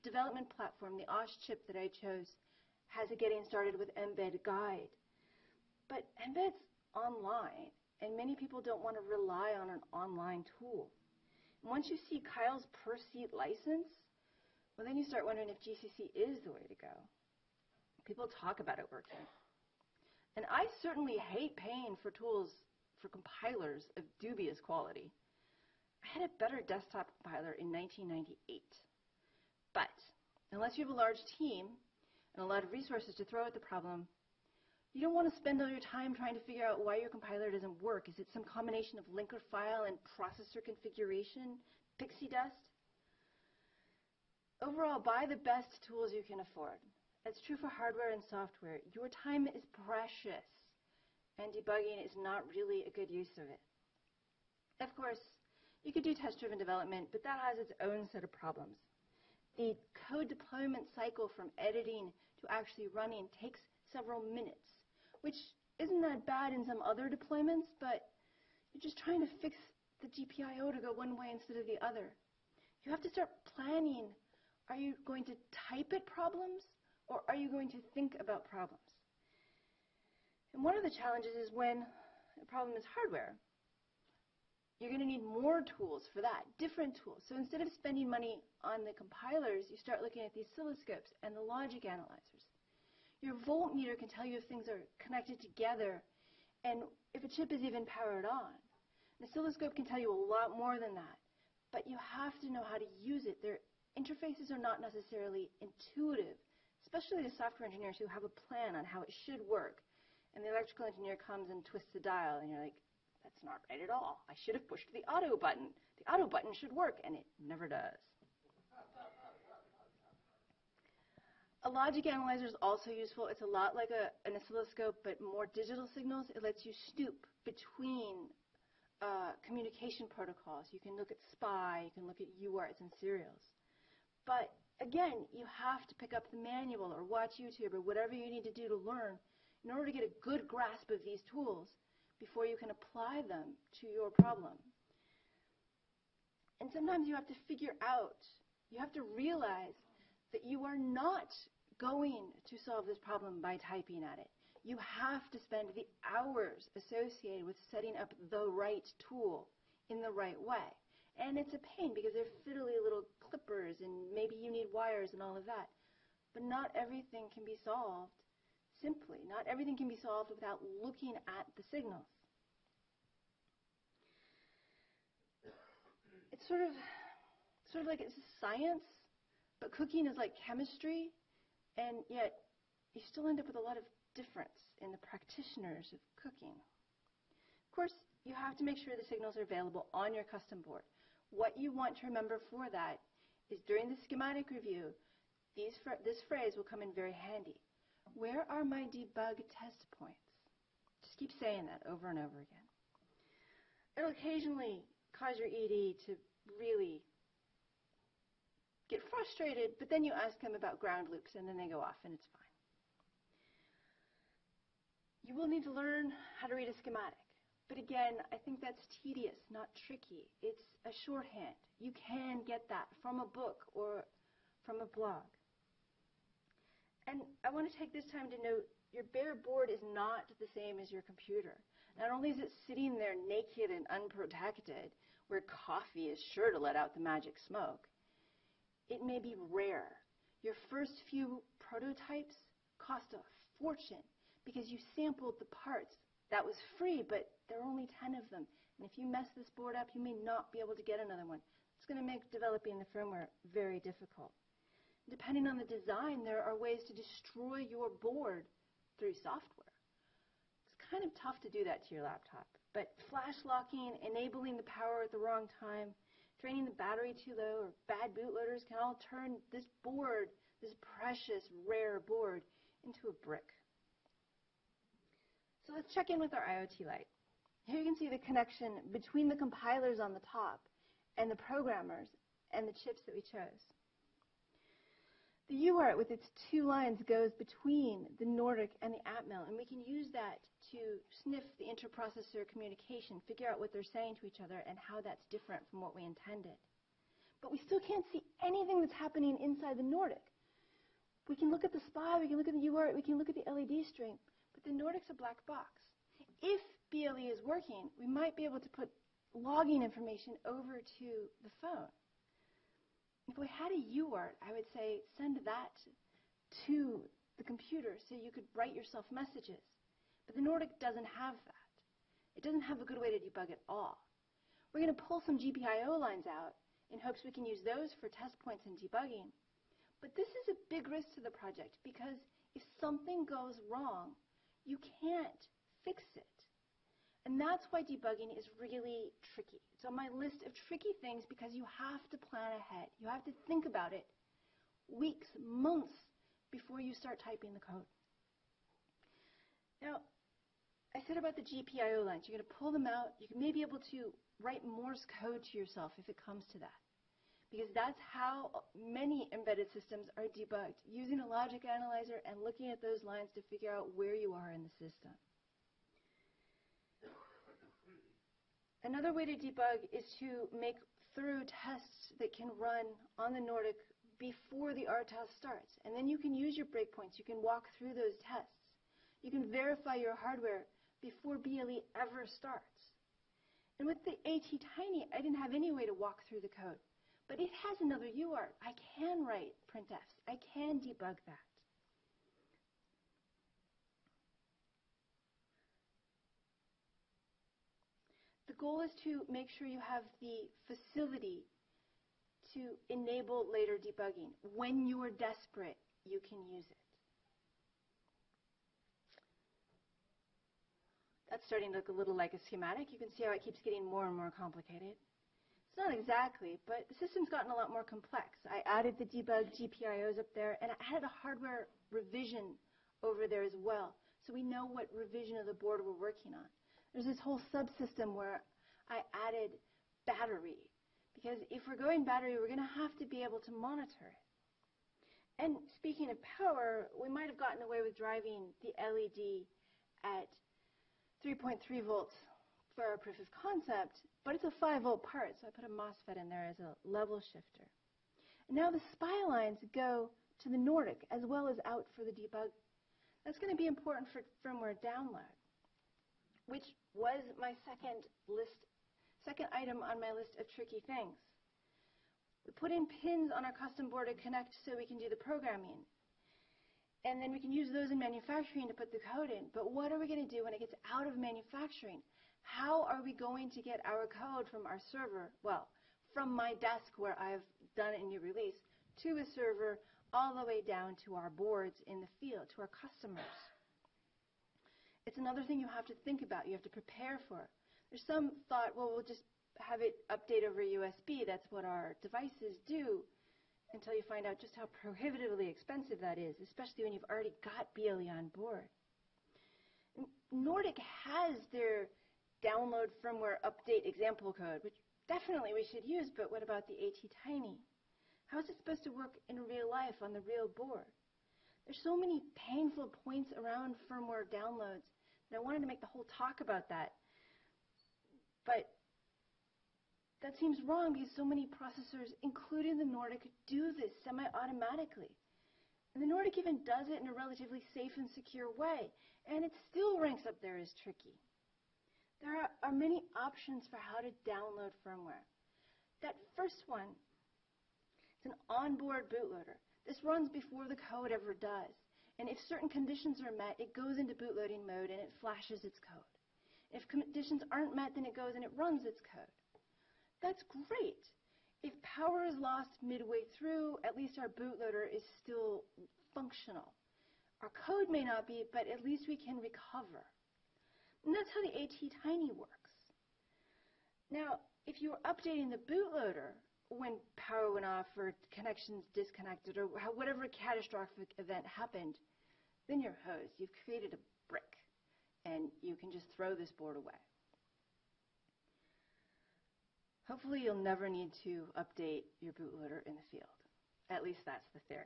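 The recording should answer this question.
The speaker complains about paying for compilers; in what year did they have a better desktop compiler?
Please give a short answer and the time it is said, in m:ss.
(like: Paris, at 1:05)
1998, at 0:27.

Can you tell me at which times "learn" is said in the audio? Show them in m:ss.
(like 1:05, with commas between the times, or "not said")
2:18, 3:35.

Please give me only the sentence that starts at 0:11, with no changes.
And once you see Keil's per seat license, well, then you start wondering if GCC is the way to go.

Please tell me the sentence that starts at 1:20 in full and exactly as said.
And one of the challenges is when the problem is hardware.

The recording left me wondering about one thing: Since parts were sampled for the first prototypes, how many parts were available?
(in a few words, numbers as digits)
10.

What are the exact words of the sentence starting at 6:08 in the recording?
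Another way to debug is to make thorough tests that can run on the Nordic before the RTOS starts.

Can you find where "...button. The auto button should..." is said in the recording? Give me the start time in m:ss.
1:55.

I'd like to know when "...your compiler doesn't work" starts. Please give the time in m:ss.
0:36.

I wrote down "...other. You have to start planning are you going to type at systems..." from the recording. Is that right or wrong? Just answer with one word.
wrong.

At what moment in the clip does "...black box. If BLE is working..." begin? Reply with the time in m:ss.
5:05.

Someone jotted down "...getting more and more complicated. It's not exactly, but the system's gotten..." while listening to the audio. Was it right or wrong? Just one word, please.
right.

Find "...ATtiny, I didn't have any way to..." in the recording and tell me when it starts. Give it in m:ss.
6:24.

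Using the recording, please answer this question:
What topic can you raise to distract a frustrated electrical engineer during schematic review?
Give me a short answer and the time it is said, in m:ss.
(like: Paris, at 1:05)
ground loops, at 3:30.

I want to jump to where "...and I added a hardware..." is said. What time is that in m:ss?
7:00.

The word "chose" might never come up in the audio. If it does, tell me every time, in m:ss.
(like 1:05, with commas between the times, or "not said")
0:01, 4:43.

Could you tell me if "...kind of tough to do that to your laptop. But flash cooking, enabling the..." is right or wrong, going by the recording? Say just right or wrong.
wrong.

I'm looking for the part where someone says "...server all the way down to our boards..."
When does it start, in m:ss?
7:59.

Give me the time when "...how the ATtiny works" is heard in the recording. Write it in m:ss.
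9:21.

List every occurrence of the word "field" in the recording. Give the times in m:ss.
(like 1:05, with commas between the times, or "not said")
8:02, 9:43.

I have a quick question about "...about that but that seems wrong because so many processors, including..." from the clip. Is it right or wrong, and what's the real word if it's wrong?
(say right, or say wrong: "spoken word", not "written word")
right.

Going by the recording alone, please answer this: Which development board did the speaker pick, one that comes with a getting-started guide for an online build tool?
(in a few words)
OSHChip.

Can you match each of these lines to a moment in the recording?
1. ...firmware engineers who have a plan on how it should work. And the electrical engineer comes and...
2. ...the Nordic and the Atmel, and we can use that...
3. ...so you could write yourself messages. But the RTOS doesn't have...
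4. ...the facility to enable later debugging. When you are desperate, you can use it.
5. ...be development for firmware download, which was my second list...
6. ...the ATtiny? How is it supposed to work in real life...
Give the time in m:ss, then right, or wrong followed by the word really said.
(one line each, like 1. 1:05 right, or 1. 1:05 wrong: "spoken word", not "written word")
1. 1:47 wrong: "software", not "firmware"
2. 4:48 right
3. 5:18 wrong: "Nordic", not "RTOS"
4. 6:40 right
5. 7:33 wrong: "important", not "development"
6. 8:26 right.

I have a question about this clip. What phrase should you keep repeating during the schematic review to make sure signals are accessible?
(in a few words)
Where are my debug test points?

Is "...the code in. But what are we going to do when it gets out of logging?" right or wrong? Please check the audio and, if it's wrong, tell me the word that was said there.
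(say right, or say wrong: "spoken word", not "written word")
wrong: "manufacturing", not "logging".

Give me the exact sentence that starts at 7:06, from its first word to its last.
There's this whole subsystem where I added battery.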